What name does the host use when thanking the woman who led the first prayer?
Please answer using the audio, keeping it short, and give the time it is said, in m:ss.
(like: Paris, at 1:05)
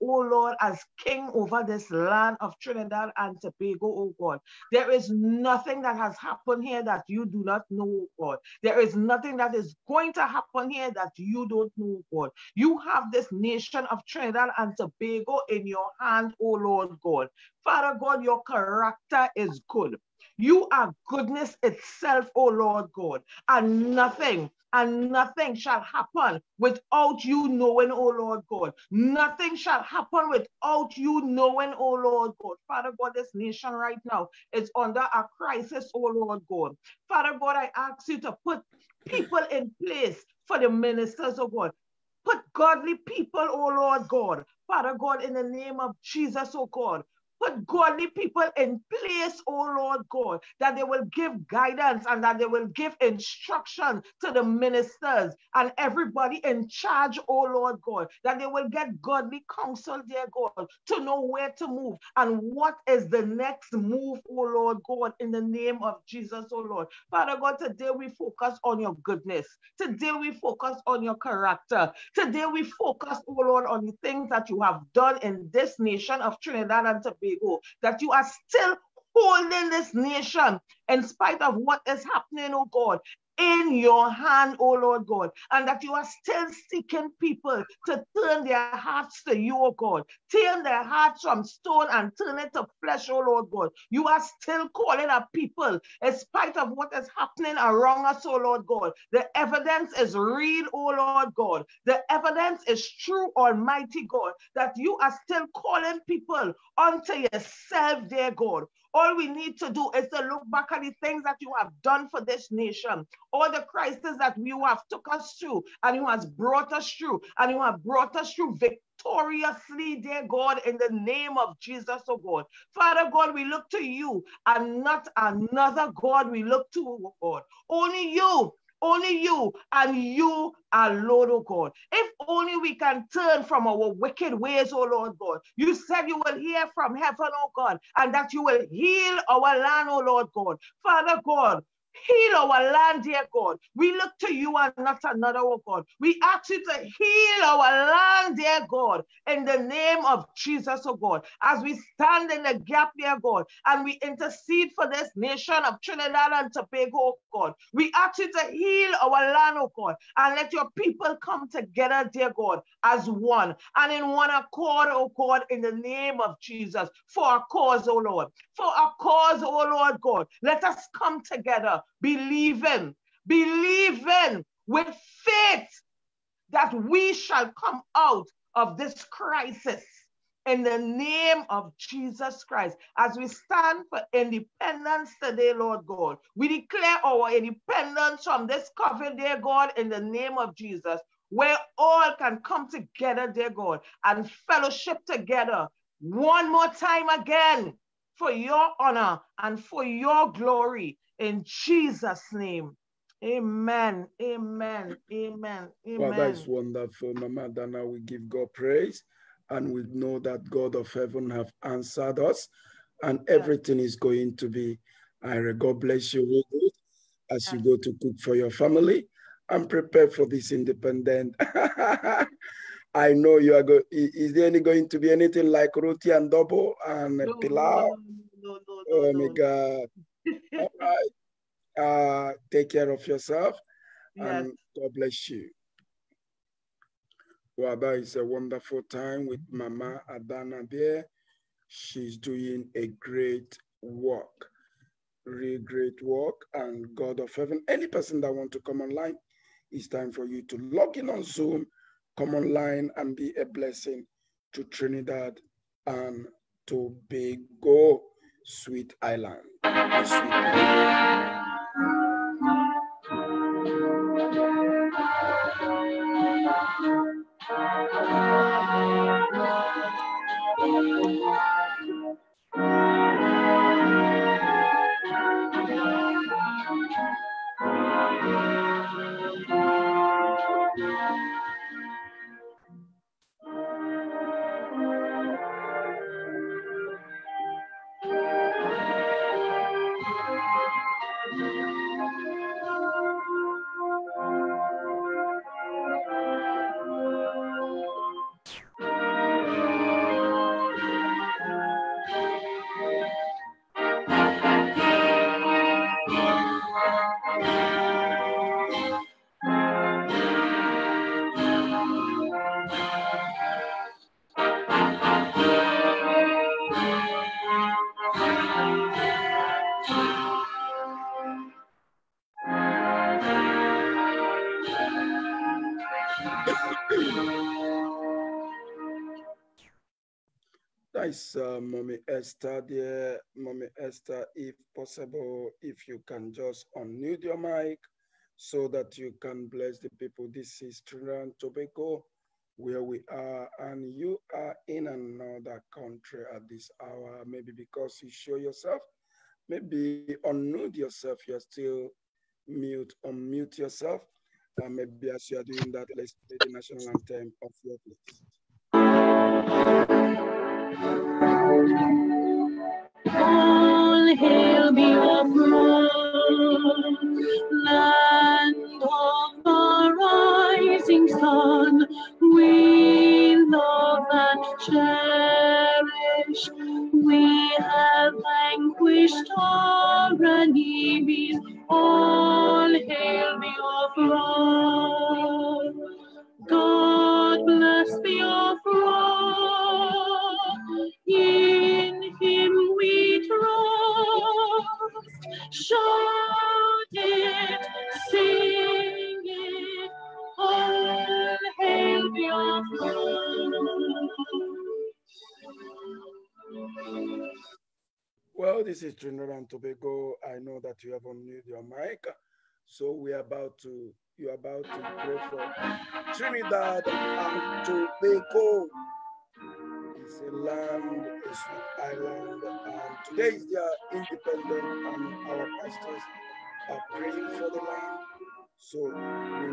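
Mama Dana, at 3:27.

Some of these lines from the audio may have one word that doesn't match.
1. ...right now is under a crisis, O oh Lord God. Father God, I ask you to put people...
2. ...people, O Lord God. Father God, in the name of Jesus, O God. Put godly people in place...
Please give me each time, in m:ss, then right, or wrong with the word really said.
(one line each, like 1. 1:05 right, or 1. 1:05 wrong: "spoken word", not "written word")
1. 0:33 right
2. 0:42 right.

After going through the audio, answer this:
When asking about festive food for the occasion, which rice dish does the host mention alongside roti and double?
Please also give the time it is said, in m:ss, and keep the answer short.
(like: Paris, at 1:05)
pilau, at 3:47.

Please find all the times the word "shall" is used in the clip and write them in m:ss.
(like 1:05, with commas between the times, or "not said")
0:25, 0:29, 2:57.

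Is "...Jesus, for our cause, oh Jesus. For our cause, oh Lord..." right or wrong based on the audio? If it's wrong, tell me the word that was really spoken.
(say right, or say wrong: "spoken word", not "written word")
wrong: "Lord", not "Jesus".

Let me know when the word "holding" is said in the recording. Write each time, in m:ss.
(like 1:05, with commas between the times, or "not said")
1:19.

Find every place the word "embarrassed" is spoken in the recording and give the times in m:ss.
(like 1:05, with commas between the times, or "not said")
not said.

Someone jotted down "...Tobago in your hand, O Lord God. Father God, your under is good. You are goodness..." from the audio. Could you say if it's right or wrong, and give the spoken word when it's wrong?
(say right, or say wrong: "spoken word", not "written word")
wrong: "character", not "under".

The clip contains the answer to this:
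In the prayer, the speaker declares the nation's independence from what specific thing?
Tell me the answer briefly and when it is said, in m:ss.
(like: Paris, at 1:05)
COVID, at 3:08.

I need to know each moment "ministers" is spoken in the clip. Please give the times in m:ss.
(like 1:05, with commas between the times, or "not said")
0:40, 0:54.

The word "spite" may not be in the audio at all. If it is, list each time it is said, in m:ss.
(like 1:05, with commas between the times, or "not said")
1:21, 1:36.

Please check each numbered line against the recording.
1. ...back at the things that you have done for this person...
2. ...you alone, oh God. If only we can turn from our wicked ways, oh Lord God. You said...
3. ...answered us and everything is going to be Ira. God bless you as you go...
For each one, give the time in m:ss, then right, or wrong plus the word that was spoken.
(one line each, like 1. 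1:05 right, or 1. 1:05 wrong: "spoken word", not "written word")
1. 1:50 wrong: "nation", not "person"
2. 2:09 right
3. 3:31 right.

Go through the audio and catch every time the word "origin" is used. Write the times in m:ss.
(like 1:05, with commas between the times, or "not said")
not said.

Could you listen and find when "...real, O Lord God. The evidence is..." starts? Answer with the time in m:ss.
1:40.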